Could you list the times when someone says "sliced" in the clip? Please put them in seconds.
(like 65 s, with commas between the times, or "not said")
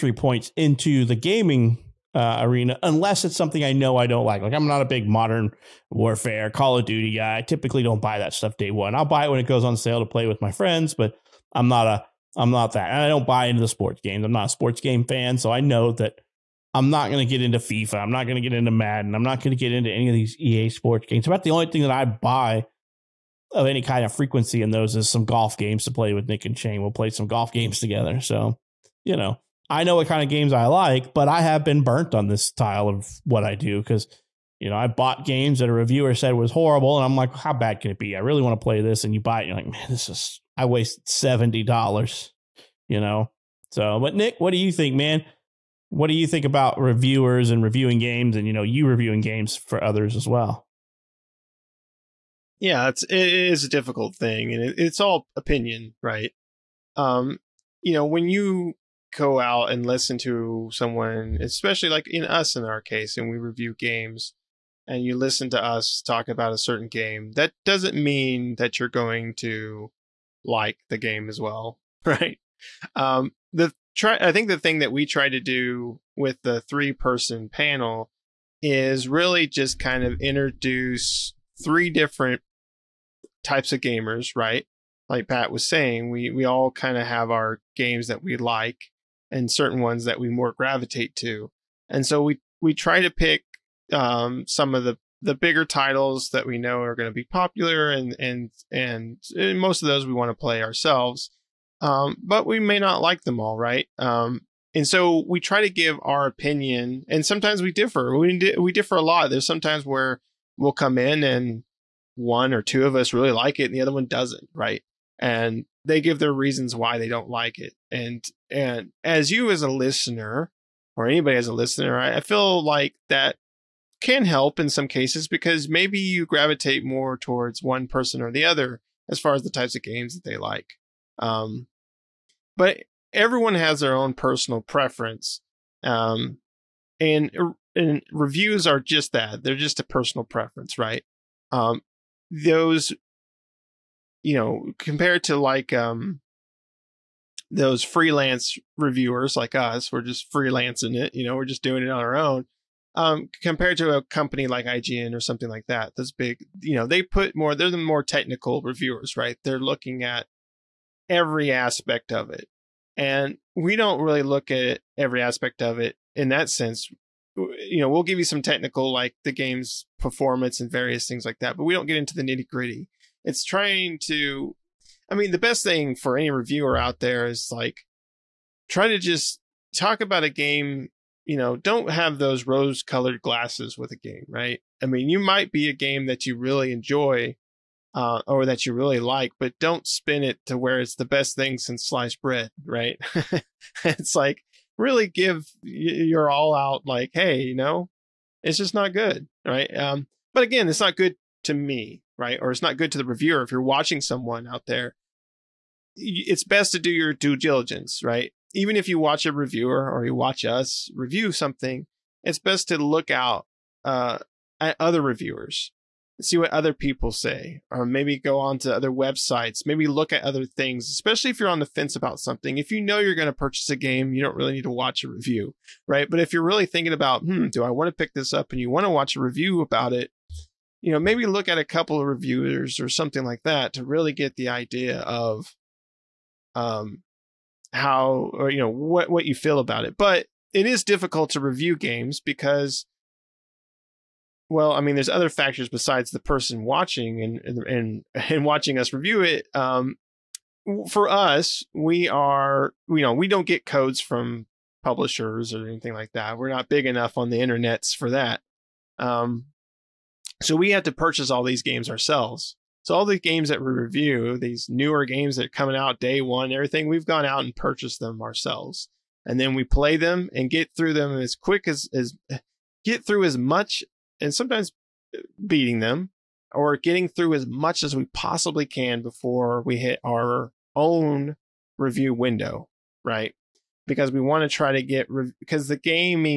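191 s.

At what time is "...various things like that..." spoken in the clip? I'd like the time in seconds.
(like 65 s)
170 s.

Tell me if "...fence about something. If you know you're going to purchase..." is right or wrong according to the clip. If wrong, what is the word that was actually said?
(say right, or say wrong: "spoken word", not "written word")
right.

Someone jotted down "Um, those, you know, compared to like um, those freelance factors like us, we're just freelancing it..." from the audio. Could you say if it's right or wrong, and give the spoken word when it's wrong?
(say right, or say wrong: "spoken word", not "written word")
wrong: "reviewers", not "factors".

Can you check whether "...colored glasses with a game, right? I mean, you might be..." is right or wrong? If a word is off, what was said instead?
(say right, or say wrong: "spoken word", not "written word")
right.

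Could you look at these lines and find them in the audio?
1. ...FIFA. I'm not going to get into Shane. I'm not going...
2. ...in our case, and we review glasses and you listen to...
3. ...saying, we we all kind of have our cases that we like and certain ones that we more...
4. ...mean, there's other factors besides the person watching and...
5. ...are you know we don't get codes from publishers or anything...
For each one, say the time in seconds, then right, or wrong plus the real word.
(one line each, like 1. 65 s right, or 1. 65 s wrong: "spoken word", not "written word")
1. 17 s wrong: "Madden", not "Shane"
2. 62 s wrong: "games", not "glasses"
3. 85 s wrong: "games", not "cases"
4. 244 s right
5. 252 s right.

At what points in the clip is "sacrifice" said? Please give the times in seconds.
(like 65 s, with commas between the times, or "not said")
not said.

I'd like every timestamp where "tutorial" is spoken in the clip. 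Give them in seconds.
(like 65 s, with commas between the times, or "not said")
not said.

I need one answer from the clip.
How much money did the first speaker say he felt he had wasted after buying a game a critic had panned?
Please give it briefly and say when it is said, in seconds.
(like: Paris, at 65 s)
$70, at 41 s.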